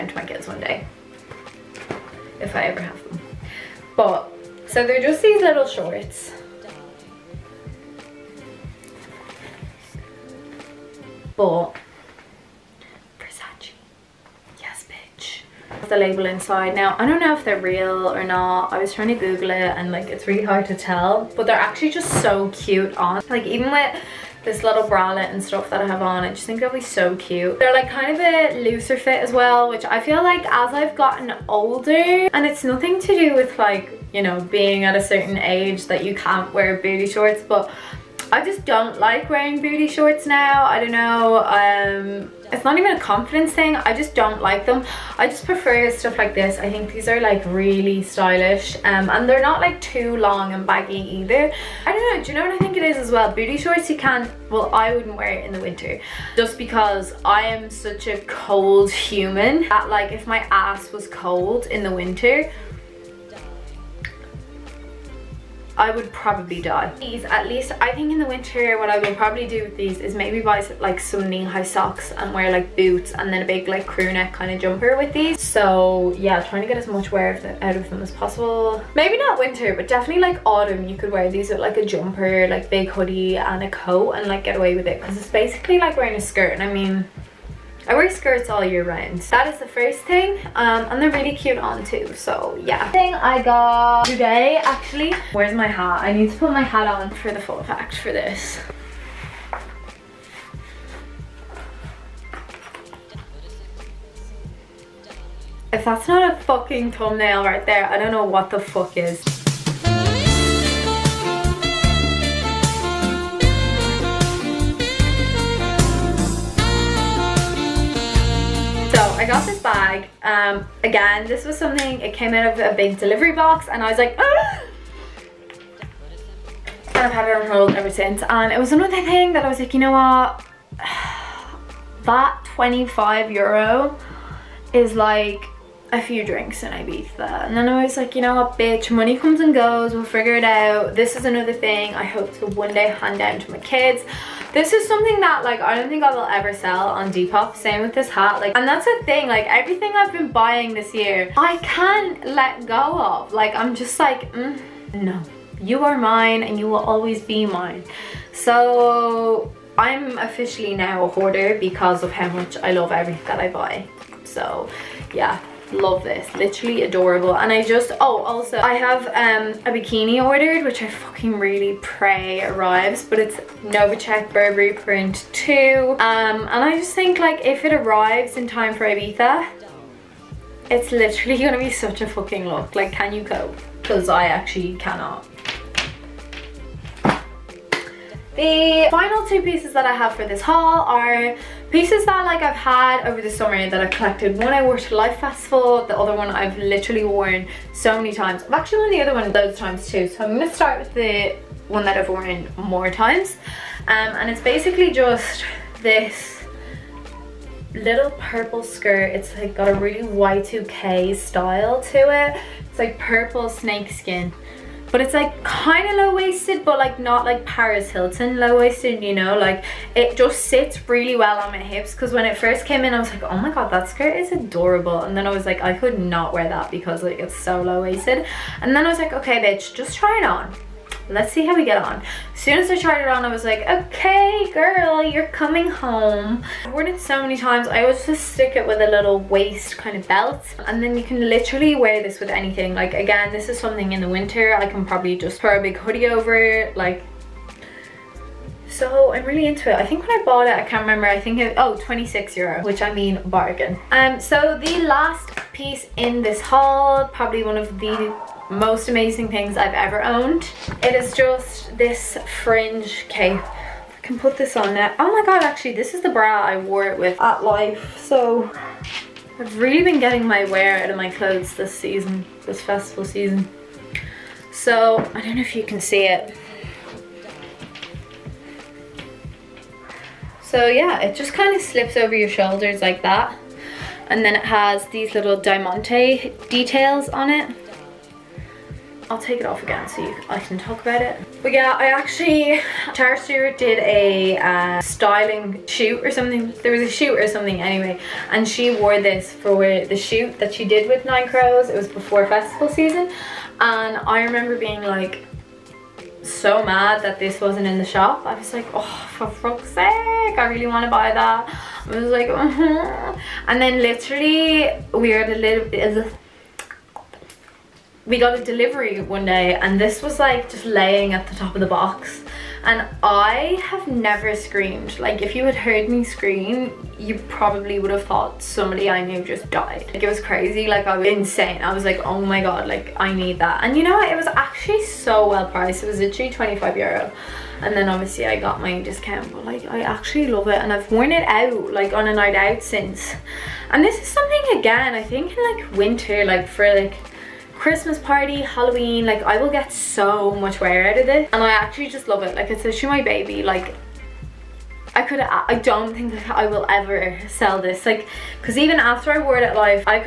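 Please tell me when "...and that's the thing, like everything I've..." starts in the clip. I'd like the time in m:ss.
2:28.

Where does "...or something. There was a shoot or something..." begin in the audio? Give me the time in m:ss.
4:56.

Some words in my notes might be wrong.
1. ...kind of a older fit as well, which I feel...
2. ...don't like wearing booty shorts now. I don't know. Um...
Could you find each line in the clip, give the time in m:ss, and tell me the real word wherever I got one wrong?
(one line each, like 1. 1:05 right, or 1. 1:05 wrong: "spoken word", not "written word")
1. 0:27 wrong: "looser", not "older"
2. 0:38 right.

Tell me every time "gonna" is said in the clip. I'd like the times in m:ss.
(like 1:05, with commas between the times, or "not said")
3:01, 3:20.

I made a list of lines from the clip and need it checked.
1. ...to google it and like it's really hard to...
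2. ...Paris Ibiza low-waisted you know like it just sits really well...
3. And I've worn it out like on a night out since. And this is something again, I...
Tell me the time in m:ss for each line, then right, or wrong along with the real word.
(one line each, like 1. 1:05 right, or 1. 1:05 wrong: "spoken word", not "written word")
1. 0:19 right
2. 3:37 wrong: "Hilton", not "Ibiza"
3. 5:40 right.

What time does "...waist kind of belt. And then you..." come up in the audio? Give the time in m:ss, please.
3:59.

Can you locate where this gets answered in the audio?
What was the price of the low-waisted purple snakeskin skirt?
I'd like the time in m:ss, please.
4:11.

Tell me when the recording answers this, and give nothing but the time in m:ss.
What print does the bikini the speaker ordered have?
2:53.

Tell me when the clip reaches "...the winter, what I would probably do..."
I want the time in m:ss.
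1:08.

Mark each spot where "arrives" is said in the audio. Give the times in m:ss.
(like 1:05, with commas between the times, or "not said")
2:52, 2:57.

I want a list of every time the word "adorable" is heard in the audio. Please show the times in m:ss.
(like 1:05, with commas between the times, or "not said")
2:46, 3:44.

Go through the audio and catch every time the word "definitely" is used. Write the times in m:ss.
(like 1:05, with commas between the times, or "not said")
1:19.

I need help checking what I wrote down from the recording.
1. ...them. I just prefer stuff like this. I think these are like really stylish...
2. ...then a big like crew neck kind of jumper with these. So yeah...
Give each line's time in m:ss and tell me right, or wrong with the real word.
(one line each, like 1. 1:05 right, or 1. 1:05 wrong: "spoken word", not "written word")
1. 0:44 right
2. 1:13 right.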